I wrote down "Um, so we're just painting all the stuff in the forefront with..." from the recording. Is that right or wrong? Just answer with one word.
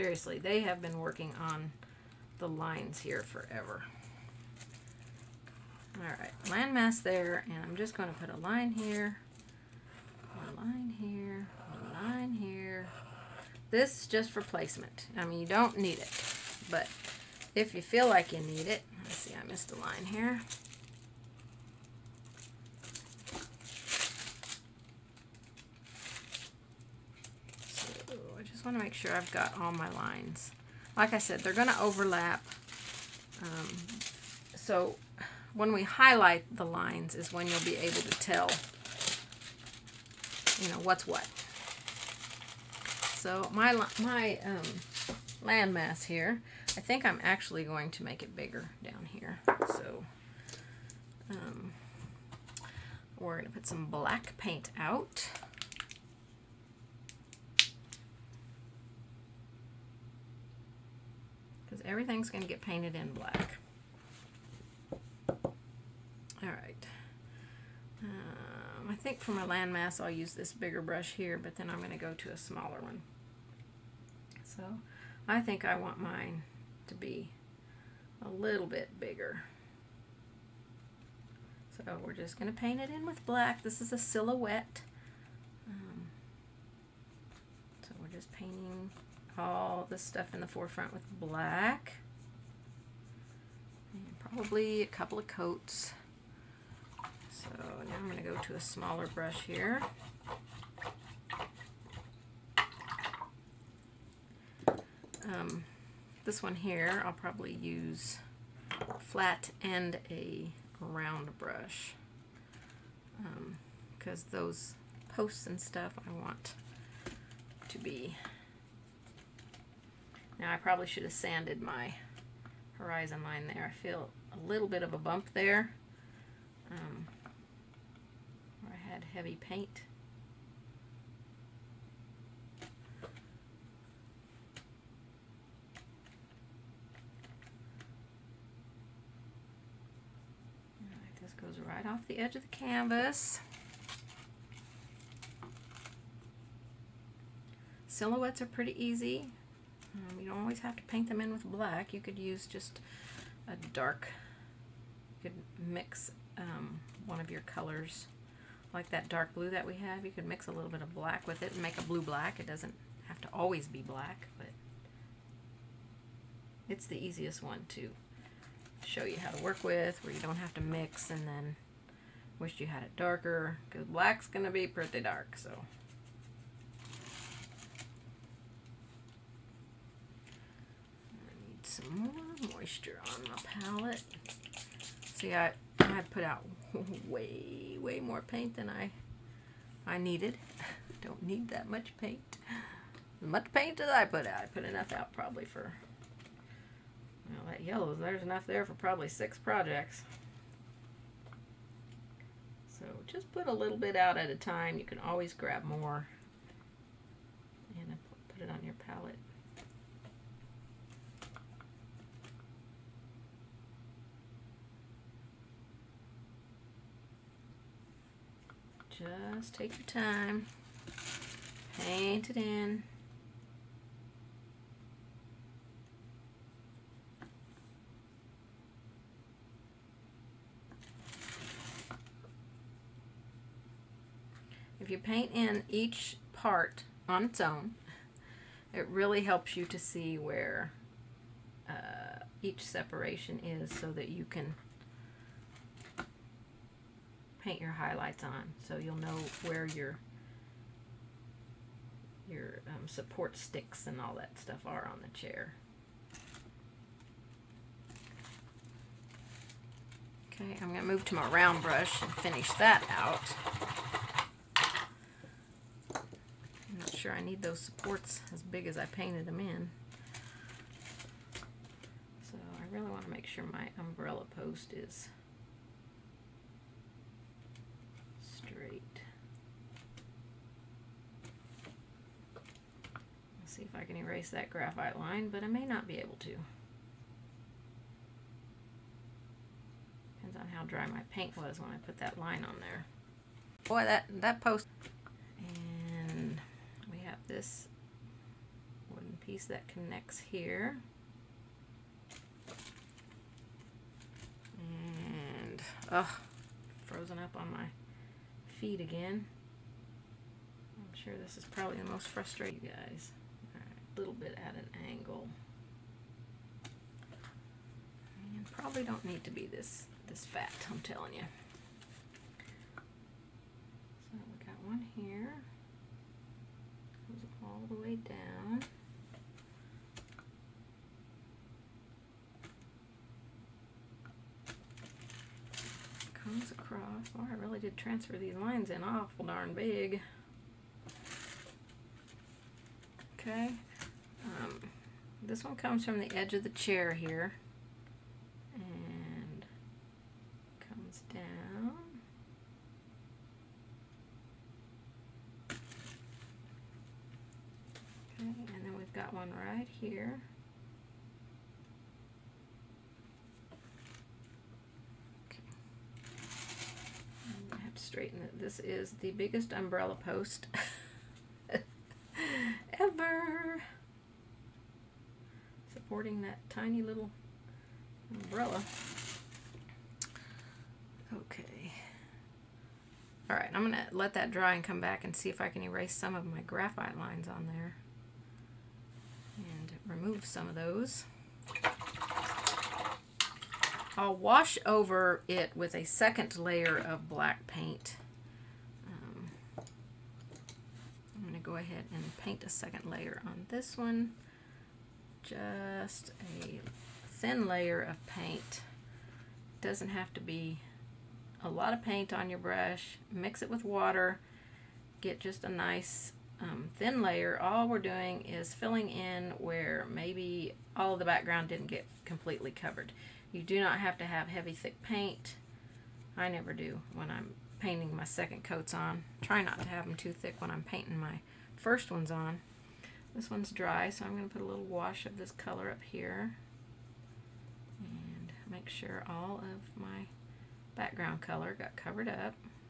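right.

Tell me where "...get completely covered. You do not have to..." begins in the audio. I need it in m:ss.
7:01.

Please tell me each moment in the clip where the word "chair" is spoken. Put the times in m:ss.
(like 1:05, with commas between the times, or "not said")
4:15, 5:46.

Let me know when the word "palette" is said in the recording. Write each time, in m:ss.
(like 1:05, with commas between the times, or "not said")
3:03, 3:28.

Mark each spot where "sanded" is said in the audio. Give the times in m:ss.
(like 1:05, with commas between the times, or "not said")
2:01.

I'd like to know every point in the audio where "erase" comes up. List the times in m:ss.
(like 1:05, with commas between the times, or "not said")
4:43, 6:25.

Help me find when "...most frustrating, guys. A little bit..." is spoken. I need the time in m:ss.
5:11.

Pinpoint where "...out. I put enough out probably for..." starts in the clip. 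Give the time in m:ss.
3:14.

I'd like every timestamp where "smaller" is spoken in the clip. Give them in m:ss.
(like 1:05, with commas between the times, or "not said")
1:12, 1:38.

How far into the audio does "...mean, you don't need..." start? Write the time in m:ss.
0:15.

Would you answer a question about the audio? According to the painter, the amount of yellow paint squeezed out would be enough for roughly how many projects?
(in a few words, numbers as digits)
6.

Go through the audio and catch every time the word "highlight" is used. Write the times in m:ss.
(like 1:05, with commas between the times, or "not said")
0:35, 4:07.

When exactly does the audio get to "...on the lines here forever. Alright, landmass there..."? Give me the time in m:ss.
0:01.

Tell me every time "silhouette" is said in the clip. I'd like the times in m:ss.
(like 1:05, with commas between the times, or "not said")
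1:23, 2:27.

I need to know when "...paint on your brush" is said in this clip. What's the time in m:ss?
6:51.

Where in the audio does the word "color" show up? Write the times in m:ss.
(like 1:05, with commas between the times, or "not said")
2:37, 7:15, 7:21.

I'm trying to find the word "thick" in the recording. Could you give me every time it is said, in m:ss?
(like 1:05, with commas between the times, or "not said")
7:04, 7:10.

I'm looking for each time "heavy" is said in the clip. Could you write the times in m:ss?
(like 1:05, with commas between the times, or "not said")
2:09, 7:04.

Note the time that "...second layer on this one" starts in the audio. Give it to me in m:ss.
6:42.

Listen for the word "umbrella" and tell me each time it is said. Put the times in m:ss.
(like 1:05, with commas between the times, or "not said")
4:33, 6:09, 6:18.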